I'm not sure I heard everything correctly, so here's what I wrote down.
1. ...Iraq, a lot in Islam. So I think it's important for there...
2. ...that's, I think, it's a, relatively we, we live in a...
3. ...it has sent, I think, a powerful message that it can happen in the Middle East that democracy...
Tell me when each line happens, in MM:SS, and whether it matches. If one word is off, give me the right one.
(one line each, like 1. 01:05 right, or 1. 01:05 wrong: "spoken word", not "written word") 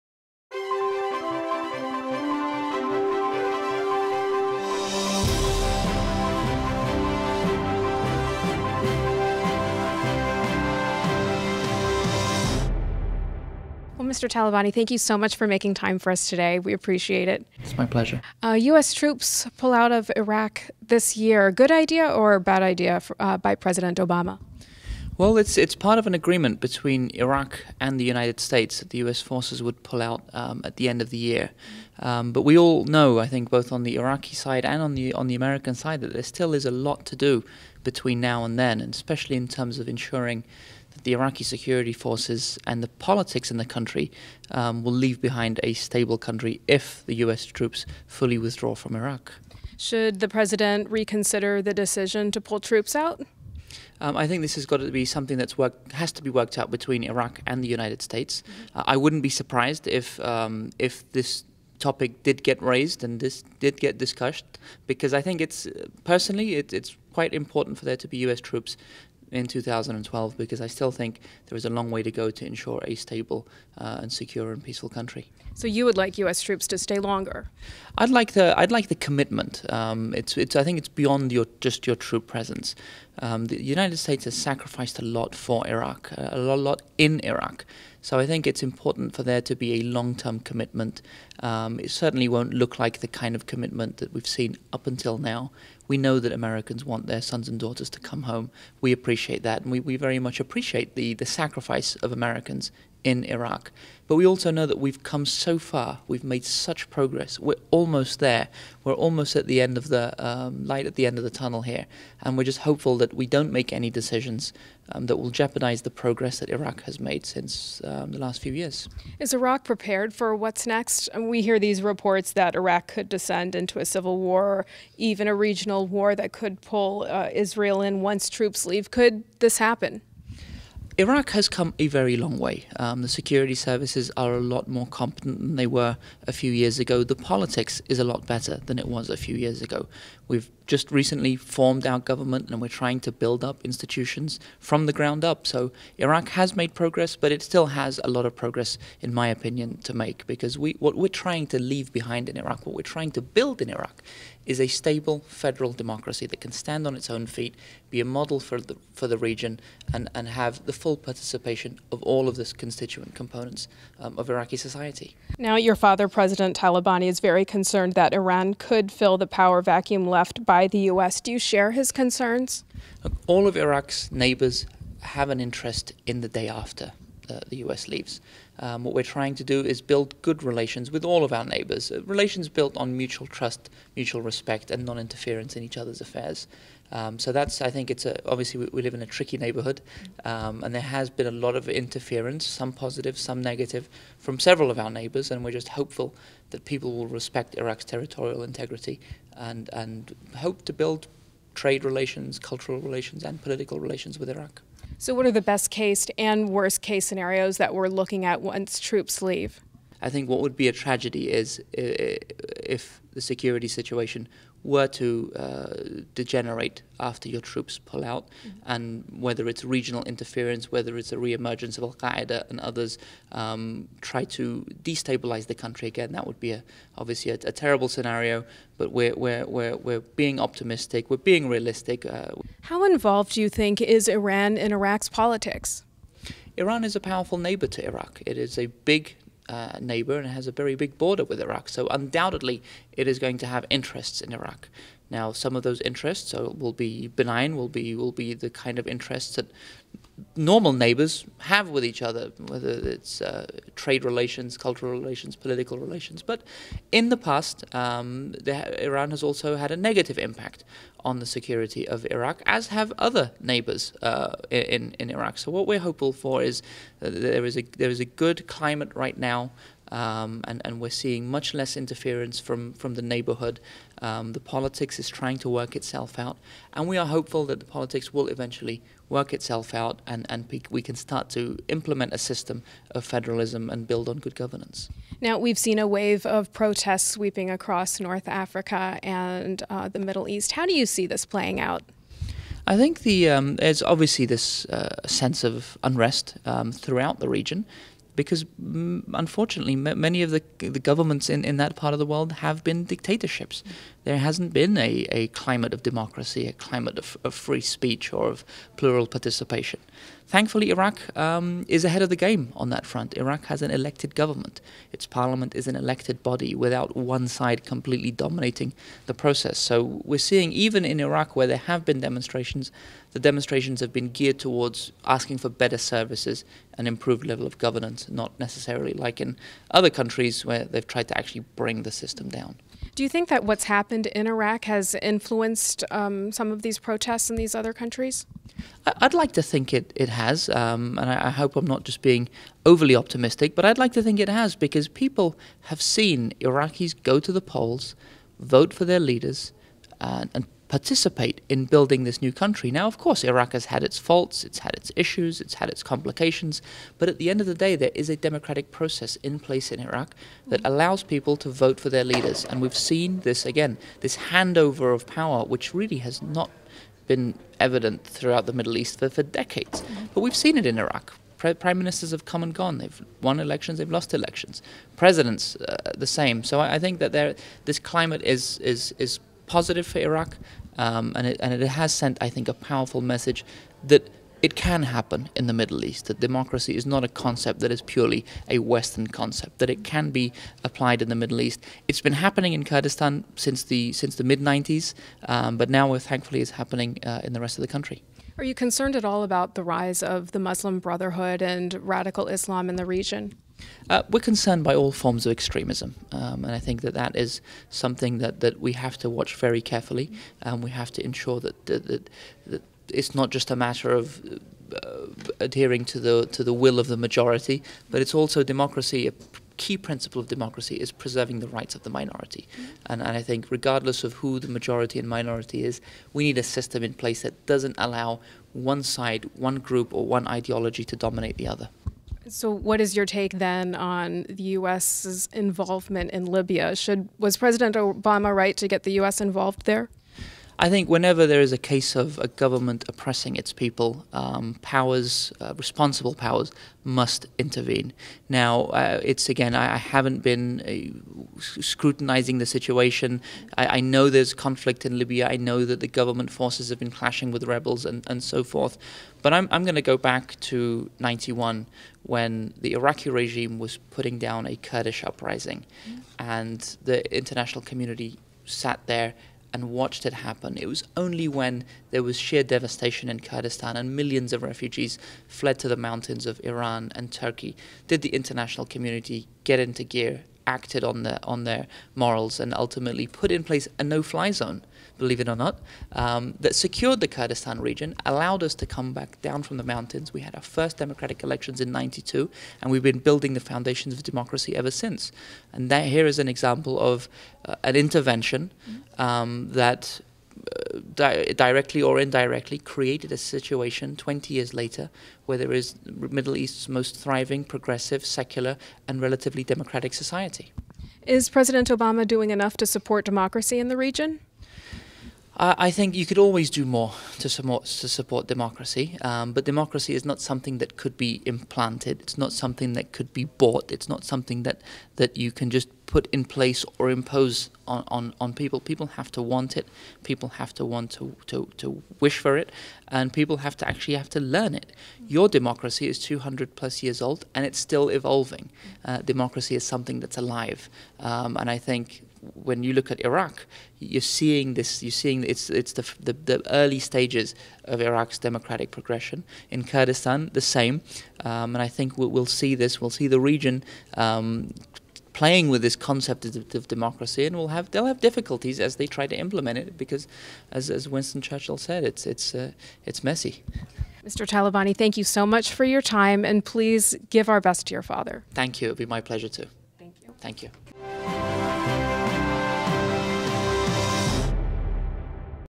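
1. 01:25 wrong: "Iraq", not "Islam"
2. 03:07 wrong: "obviously", not "relatively"
3. 06:21 right.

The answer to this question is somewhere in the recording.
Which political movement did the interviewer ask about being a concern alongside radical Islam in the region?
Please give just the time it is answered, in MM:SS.
06:40.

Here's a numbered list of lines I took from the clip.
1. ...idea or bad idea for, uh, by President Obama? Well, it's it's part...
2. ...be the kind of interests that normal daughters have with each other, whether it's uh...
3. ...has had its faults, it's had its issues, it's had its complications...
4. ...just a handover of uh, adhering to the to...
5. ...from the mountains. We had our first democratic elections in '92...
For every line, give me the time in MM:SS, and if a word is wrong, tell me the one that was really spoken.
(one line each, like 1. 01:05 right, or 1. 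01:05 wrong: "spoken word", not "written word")
1. 00:21 right
2. 04:08 wrong: "neighbors", not "daughters"
3. 05:53 right
4. 06:53 wrong: "matter", not "handover"
5. 08:09 right.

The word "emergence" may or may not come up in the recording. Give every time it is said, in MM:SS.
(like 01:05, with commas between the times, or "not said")
03:41.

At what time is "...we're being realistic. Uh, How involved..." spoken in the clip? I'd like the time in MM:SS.
03:51.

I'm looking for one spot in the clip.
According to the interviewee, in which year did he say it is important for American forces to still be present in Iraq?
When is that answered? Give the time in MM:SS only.
01:09.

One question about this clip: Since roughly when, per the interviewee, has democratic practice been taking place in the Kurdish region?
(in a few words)
mid 90s.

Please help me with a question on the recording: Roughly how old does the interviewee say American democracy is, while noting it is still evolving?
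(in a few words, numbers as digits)
200 plus years.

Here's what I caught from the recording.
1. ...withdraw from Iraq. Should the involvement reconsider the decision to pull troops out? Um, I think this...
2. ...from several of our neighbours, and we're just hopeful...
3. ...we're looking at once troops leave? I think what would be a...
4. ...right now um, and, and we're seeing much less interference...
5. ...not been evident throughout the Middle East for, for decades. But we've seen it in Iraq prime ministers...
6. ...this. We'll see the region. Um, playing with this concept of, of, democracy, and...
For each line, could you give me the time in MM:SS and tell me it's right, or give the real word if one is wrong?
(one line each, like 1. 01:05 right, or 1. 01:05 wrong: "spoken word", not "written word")
1. 00:48 wrong: "president", not "involvement"
2. 03:14 right
3. 03:27 right
4. 04:28 right
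5. 06:06 right
6. 09:12 right.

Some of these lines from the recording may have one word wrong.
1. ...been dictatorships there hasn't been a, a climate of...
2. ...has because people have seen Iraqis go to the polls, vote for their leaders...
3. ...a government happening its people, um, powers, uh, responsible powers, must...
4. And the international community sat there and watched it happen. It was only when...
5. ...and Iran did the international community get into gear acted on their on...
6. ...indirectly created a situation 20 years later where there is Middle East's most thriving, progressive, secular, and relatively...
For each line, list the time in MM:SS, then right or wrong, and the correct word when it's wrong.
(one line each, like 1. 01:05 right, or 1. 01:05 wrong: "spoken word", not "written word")
1. 05:02 right
2. 05:44 right
3. 07:22 wrong: "oppressing", not "happening"
4. 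07:46 right
5. 07:56 wrong: "Turkey", not "Iran"
6. 08:21 right.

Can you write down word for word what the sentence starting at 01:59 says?
Is Iraq prepared for what's next?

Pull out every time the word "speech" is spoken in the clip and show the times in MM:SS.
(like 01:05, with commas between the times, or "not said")
05:07.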